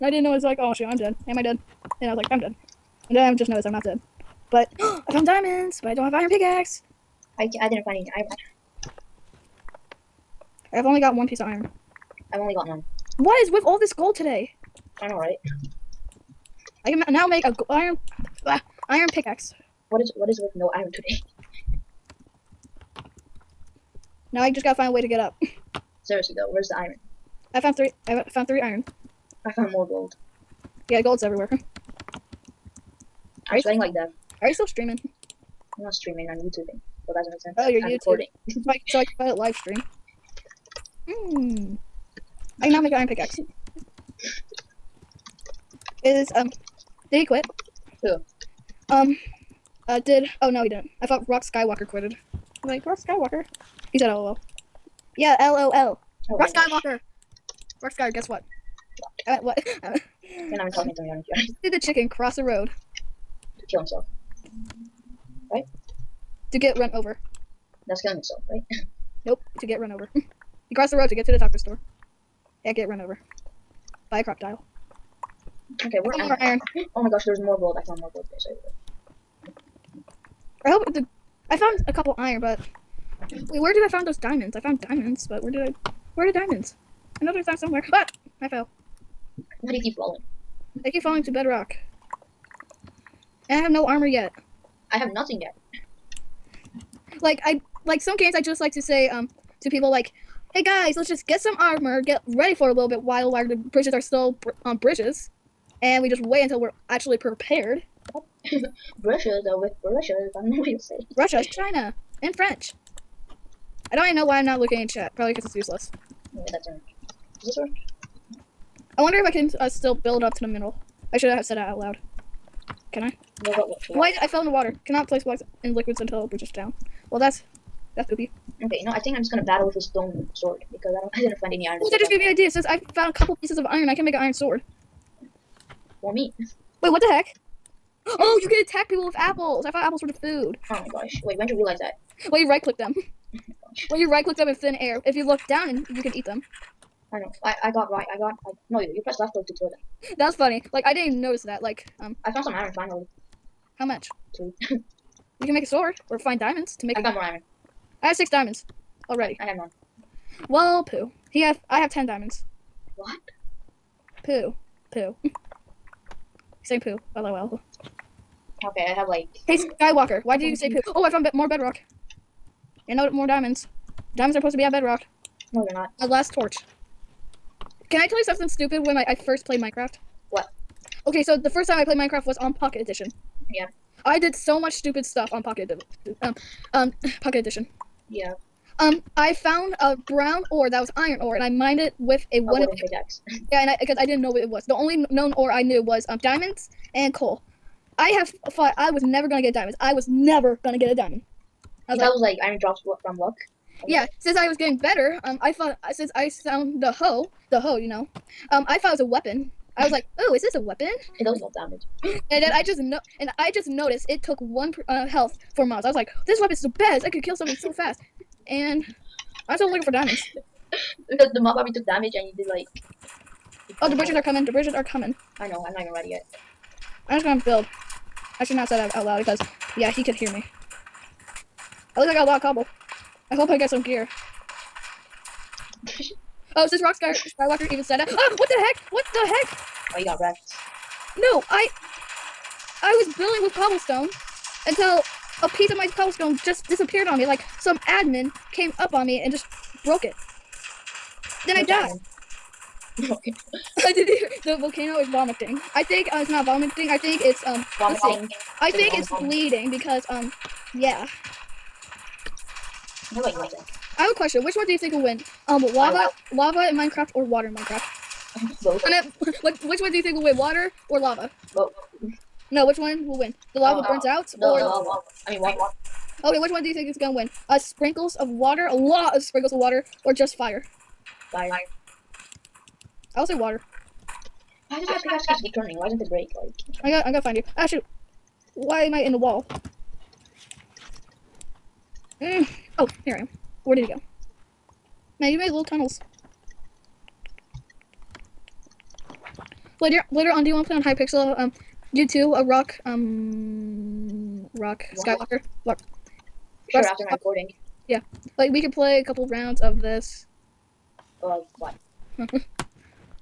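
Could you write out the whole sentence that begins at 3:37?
I could kill something so fast, and.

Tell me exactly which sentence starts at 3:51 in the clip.
At least I got a lot of cobble.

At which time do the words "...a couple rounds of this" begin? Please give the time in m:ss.
5:09.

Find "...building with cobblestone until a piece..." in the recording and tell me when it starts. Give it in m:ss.
4:03.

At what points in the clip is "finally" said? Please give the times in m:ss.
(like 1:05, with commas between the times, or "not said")
2:32.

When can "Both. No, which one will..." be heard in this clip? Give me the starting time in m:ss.
4:31.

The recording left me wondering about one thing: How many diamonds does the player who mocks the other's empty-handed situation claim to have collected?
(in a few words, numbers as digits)
10.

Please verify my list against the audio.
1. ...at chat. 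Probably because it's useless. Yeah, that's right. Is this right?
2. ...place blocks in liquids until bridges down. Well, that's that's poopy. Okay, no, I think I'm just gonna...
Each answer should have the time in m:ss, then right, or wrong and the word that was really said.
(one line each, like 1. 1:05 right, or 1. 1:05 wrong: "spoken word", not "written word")
1. 1:54 right
2. 2:05 right.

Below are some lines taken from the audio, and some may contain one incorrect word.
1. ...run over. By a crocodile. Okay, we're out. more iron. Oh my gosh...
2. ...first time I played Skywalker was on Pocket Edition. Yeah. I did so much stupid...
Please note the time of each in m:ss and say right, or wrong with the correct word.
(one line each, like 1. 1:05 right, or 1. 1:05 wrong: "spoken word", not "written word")
1. 1:12 right
2. 3:01 wrong: "Minecraft", not "Skywalker".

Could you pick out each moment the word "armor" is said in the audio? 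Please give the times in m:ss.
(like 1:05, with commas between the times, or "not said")
1:33, 1:41.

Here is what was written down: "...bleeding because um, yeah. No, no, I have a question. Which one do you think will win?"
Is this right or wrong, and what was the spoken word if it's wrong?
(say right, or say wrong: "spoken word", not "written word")
right.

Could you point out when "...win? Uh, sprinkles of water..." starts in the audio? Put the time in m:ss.
4:37.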